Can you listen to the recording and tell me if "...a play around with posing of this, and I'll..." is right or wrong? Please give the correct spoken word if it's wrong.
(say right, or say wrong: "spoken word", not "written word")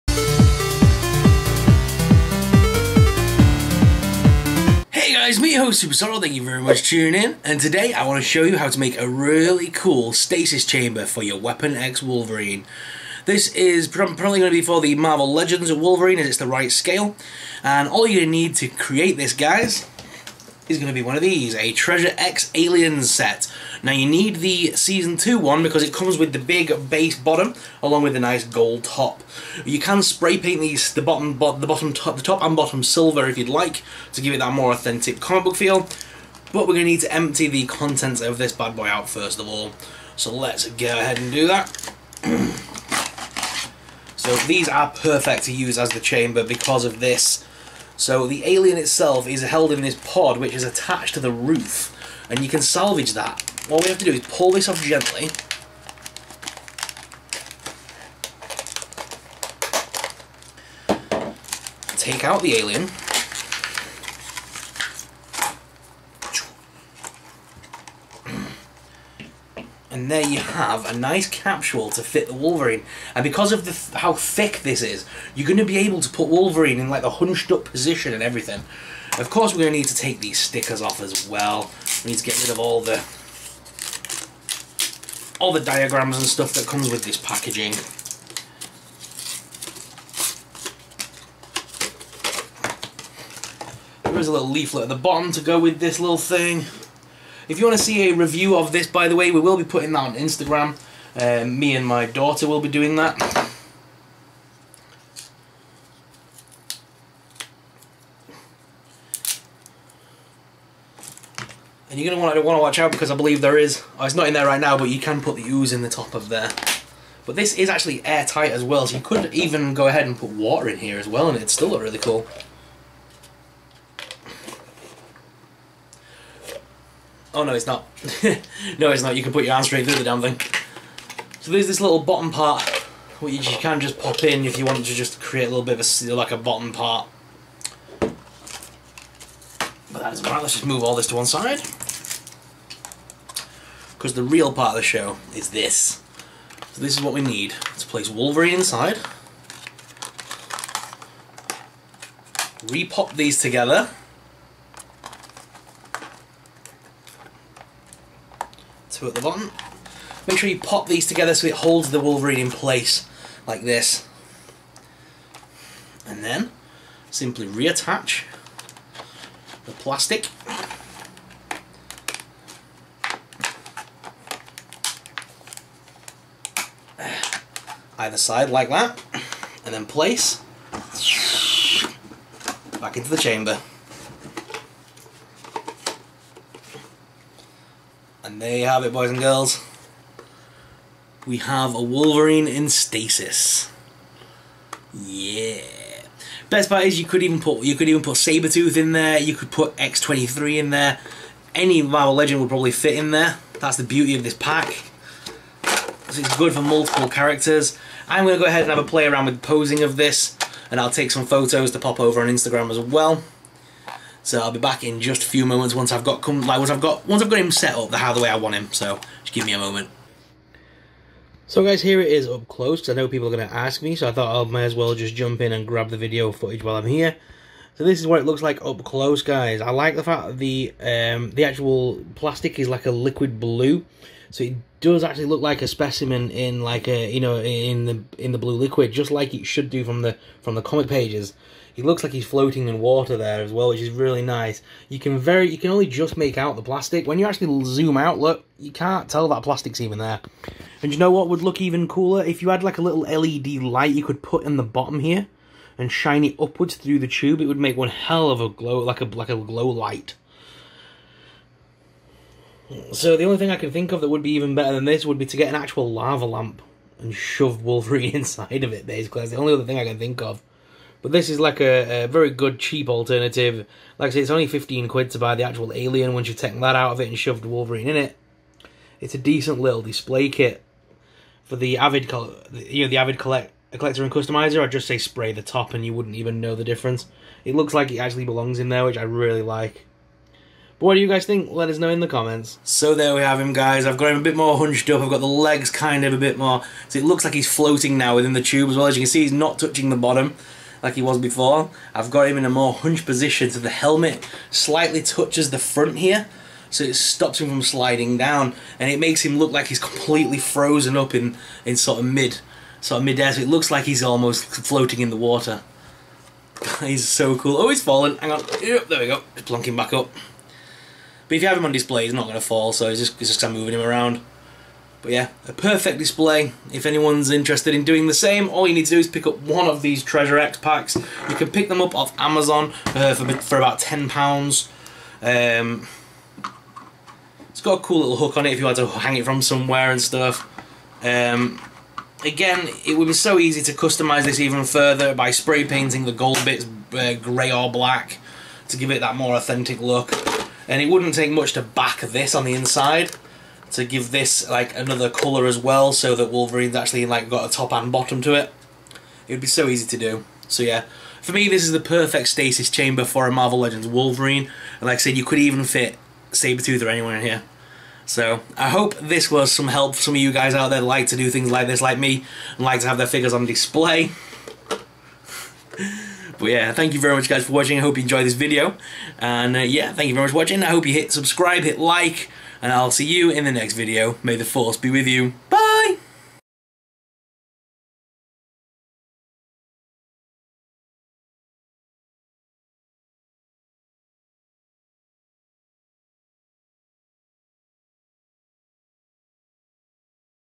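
right.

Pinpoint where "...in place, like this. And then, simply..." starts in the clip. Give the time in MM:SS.
02:42.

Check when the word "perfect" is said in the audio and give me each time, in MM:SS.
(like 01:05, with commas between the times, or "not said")
00:44, 05:25, 06:01.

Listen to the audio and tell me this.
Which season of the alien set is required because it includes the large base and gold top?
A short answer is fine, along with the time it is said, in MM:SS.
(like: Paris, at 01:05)
Season 2, at 00:24.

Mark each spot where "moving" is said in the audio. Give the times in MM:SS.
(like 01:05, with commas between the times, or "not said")
05:23.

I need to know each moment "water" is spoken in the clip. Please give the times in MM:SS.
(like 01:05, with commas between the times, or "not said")
02:00, 04:02, 05:15.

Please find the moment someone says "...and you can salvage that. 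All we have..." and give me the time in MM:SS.
00:52.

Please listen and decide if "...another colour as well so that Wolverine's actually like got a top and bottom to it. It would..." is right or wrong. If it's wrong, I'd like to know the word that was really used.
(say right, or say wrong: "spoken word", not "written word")
right.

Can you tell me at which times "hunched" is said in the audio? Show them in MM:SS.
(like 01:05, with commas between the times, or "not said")
01:17, 04:54, 05:02.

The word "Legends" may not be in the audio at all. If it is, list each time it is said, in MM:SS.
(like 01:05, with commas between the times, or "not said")
00:15, 03:22, 06:03.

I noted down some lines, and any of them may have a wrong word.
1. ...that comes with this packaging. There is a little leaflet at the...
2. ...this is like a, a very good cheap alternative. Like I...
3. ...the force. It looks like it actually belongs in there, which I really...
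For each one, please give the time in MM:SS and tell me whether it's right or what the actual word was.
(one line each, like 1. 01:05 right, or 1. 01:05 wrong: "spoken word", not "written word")
1. 01:26 right
2. 04:31 right
3. 04:46 wrong: "difference", not "force".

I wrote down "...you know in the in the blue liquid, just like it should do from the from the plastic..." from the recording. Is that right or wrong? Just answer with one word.
wrong.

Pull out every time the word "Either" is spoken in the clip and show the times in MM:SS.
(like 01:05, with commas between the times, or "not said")
02:57.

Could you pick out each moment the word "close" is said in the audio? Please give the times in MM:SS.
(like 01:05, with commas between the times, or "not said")
03:42, 03:48.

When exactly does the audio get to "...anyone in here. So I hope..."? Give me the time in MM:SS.
06:06.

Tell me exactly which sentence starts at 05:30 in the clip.
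You can pick them up off Amazon uh, for, for about £10.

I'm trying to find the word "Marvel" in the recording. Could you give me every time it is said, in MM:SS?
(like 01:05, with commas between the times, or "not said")
00:14, 03:21, 06:03.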